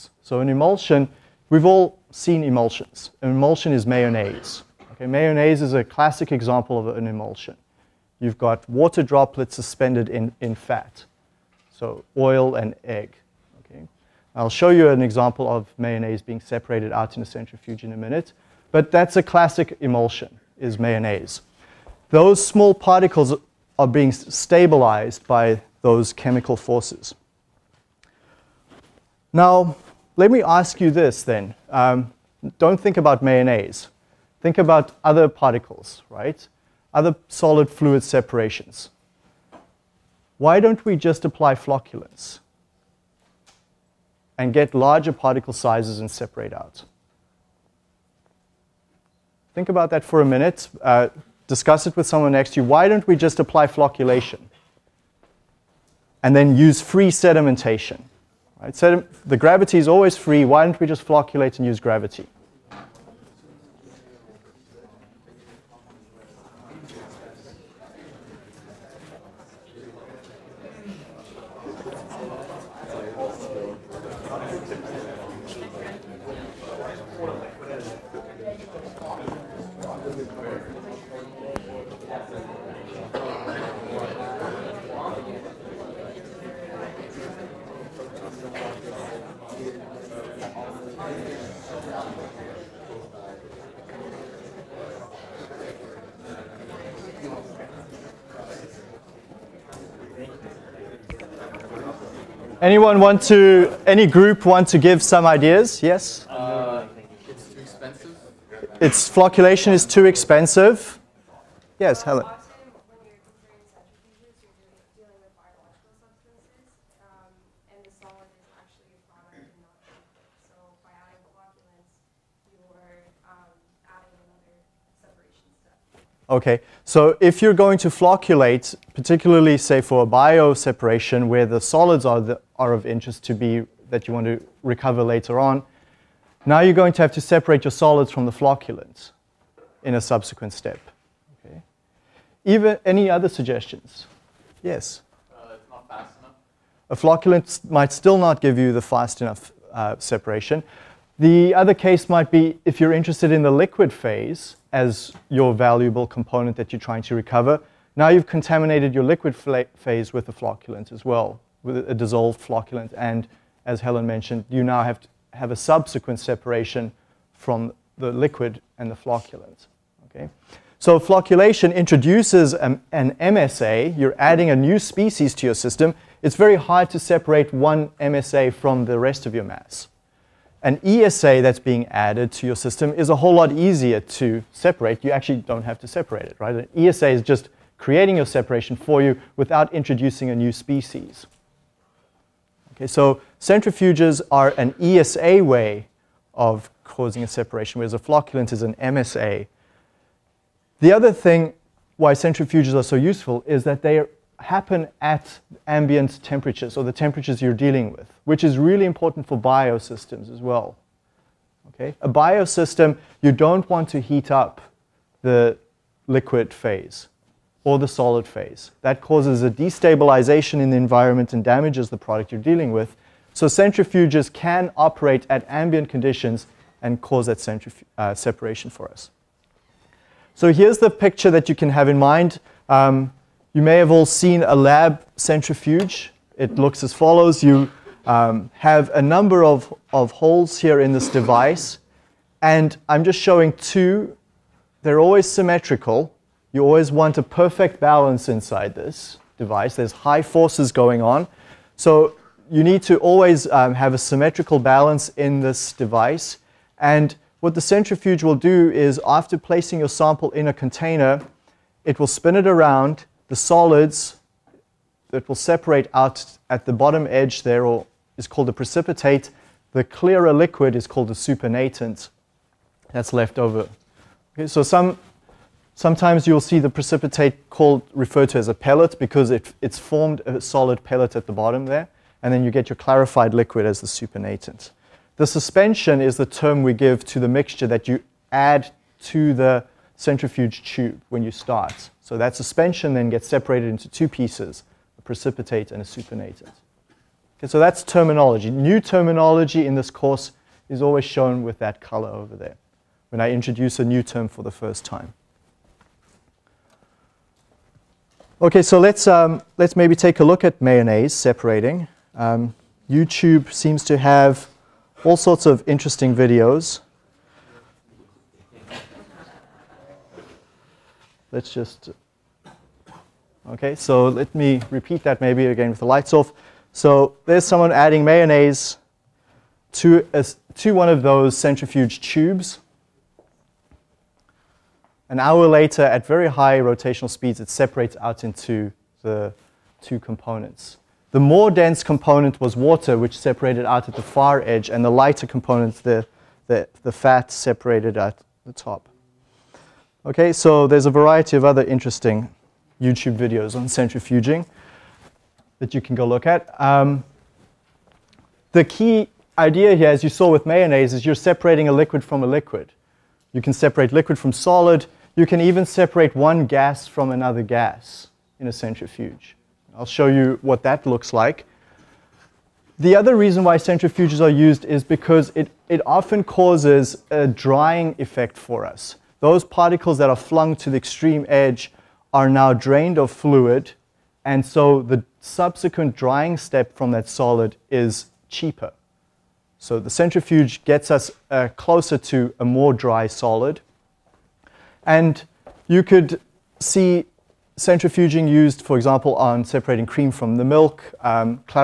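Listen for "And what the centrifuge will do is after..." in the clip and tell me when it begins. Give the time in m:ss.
4:16.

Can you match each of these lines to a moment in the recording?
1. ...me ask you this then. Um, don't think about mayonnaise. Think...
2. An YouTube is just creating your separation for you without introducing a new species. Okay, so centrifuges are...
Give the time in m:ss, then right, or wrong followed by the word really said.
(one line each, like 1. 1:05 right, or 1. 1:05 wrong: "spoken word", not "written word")
1. 0:30 right
2. 3:06 wrong: "ESA", not "YouTube".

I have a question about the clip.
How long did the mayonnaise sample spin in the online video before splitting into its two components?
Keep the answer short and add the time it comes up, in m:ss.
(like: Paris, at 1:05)
An hour, at 5:35.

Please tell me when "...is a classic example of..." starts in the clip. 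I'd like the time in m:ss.
0:05.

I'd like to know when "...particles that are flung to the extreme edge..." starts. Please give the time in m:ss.
6:19.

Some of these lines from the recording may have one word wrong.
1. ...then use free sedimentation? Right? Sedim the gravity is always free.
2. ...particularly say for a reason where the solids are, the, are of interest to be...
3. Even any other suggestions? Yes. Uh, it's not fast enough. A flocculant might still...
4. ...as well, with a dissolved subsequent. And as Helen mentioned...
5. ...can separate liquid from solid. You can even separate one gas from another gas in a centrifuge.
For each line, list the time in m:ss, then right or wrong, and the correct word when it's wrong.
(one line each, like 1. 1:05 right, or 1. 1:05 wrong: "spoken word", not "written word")
1. 0:56 right
2. 2:08 wrong: "bioseparation", not "reason"
3. 2:22 right
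4. 2:40 wrong: "flocculant", not "subsequent"
5. 6:03 right.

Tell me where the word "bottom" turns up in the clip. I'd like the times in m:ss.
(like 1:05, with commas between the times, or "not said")
4:26, 4:41.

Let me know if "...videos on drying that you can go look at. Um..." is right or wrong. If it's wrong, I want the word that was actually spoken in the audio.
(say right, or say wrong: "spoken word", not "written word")
wrong: "centrifuging", not "drying".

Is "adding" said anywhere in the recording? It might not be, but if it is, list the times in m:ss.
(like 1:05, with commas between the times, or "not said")
2:54, 5:27.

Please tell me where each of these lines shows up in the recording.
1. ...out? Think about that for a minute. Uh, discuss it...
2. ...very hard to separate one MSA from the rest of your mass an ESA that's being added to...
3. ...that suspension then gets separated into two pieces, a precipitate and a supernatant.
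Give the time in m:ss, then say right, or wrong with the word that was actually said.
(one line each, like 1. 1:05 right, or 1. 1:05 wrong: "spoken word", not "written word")
1. 0:46 right
2. 2:56 right
3. 4:52 right.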